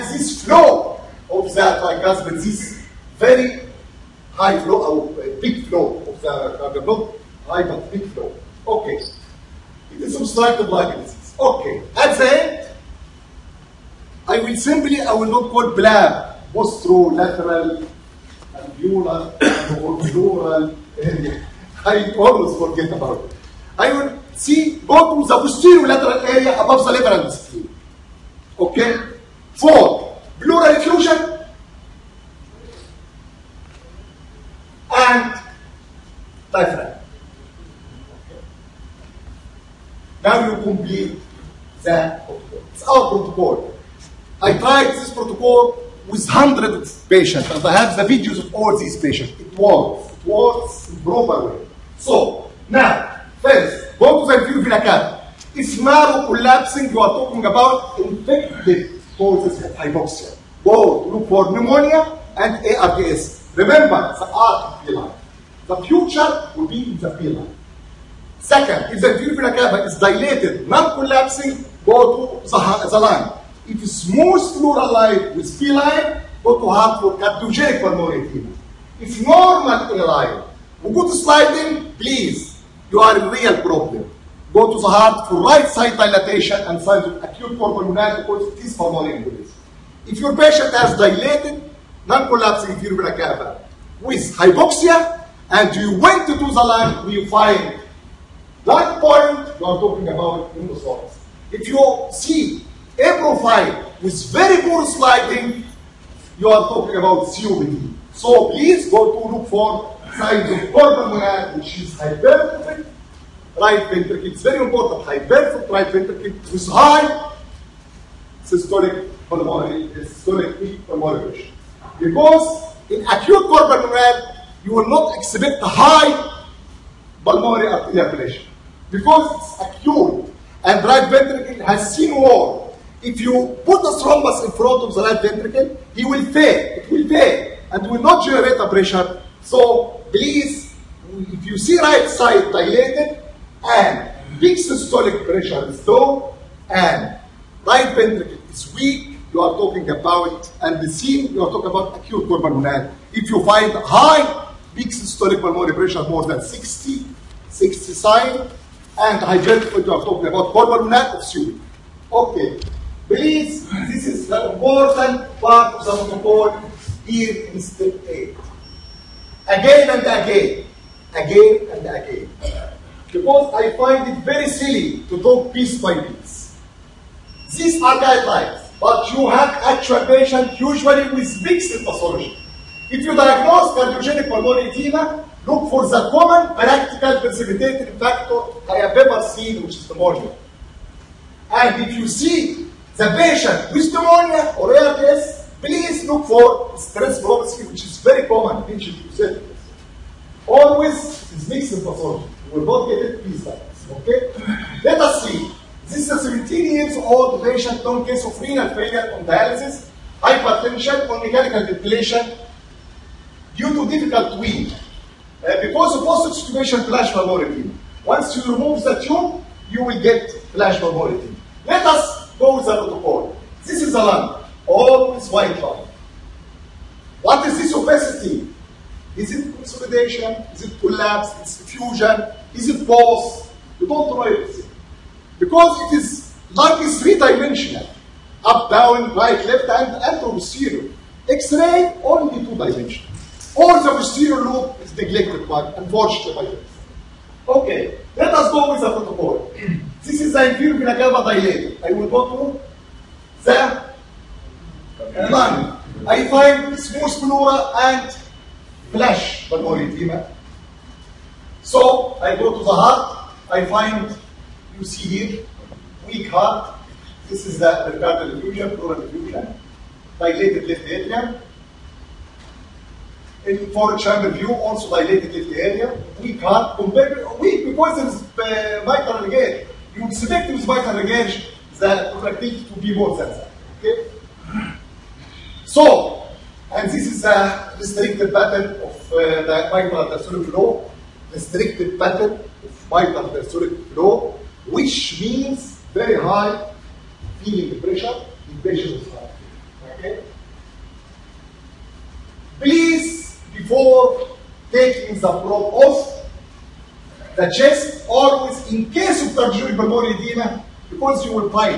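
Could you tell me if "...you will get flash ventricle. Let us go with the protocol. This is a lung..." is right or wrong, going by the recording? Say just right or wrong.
wrong.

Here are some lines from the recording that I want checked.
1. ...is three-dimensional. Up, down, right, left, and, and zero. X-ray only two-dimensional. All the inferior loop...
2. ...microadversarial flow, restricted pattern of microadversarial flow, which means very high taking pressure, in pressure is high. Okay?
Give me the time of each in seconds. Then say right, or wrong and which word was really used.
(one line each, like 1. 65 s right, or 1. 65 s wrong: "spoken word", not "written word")
1. 236 s wrong: "posterior", not "inferior"
2. 289 s wrong: "feeling", not "taking".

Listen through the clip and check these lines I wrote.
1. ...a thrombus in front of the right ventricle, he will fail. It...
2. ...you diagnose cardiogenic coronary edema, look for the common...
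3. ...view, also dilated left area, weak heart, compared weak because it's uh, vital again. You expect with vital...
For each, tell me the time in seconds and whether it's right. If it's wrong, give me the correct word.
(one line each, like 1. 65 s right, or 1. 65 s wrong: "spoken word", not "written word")
1. 133 s right
2. 183 s wrong: "pulmonary", not "coronary"
3. 274 s right.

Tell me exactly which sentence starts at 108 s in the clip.
So please go to look for signs of pulmonary, which is hypertrophic right ventricle.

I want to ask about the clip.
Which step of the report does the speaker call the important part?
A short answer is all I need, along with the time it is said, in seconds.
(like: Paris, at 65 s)
Step 8, at 167 s.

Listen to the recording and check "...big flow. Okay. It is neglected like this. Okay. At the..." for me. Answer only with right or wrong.
wrong.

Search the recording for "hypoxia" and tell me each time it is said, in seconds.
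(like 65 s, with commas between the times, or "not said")
59 s, 94 s.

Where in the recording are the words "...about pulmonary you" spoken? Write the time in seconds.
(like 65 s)
160 s.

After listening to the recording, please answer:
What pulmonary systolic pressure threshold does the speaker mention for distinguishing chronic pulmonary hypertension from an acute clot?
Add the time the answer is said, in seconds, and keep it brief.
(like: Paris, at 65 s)
60 to 65, at 156 s.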